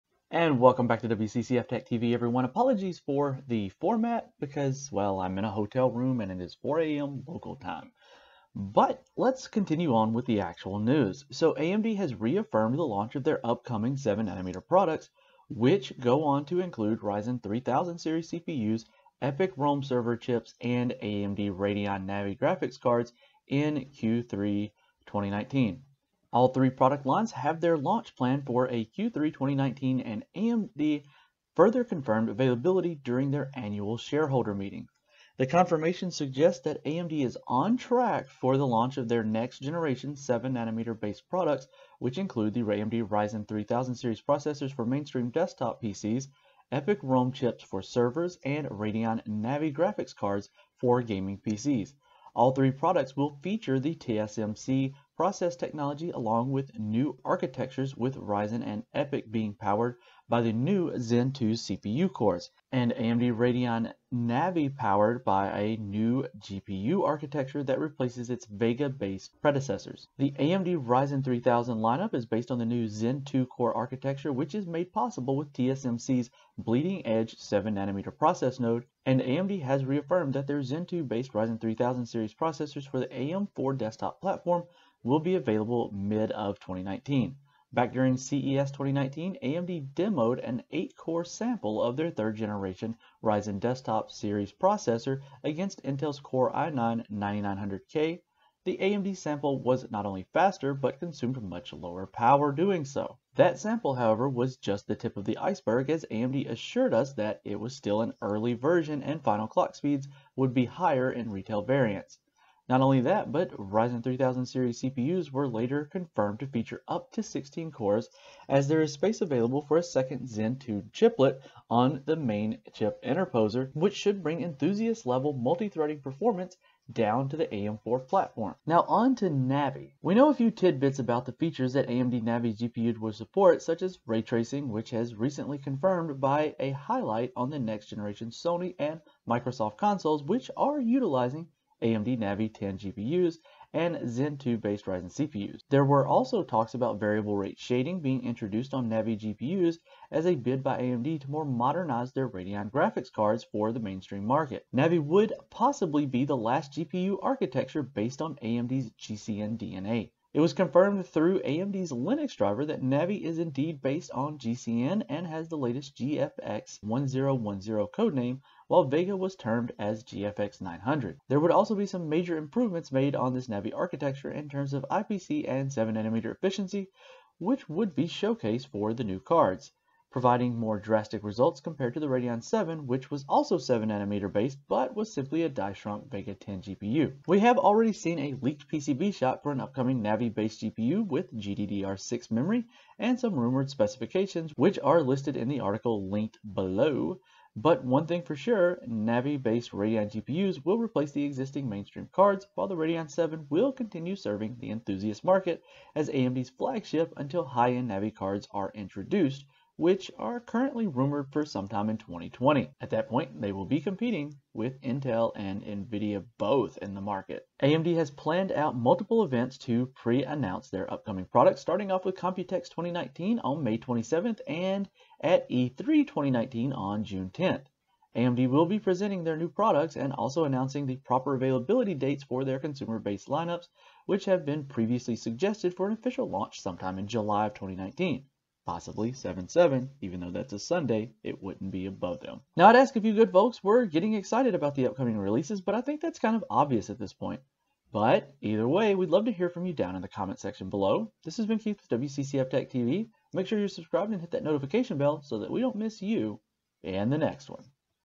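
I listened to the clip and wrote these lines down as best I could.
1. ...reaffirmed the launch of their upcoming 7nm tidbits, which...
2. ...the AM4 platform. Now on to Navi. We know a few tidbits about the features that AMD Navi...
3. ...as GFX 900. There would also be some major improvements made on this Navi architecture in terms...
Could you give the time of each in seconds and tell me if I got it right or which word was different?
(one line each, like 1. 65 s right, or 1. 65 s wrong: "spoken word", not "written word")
1. 12 s wrong: "products", not "tidbits"
2. 127 s right
3. 169 s right.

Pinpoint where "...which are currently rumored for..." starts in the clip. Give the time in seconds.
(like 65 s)
209 s.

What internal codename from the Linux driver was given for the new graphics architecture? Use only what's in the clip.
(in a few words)
GFX 1010.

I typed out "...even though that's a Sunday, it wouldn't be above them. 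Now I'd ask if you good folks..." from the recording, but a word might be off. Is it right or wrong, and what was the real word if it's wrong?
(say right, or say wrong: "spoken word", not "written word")
right.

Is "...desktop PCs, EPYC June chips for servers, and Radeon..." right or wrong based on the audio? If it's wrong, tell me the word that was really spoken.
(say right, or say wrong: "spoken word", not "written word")
wrong: "Rome", not "June".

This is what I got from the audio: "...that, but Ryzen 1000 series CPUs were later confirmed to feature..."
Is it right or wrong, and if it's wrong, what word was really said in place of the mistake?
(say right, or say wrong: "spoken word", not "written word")
wrong: "3000", not "1000".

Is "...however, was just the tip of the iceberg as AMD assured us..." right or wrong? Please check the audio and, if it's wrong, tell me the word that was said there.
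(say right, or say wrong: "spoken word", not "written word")
right.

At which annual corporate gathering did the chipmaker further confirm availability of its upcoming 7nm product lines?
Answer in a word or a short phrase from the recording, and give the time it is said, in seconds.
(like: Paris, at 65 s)
shareholder meeting, at 33 s.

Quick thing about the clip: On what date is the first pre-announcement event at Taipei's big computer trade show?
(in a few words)
May 27th.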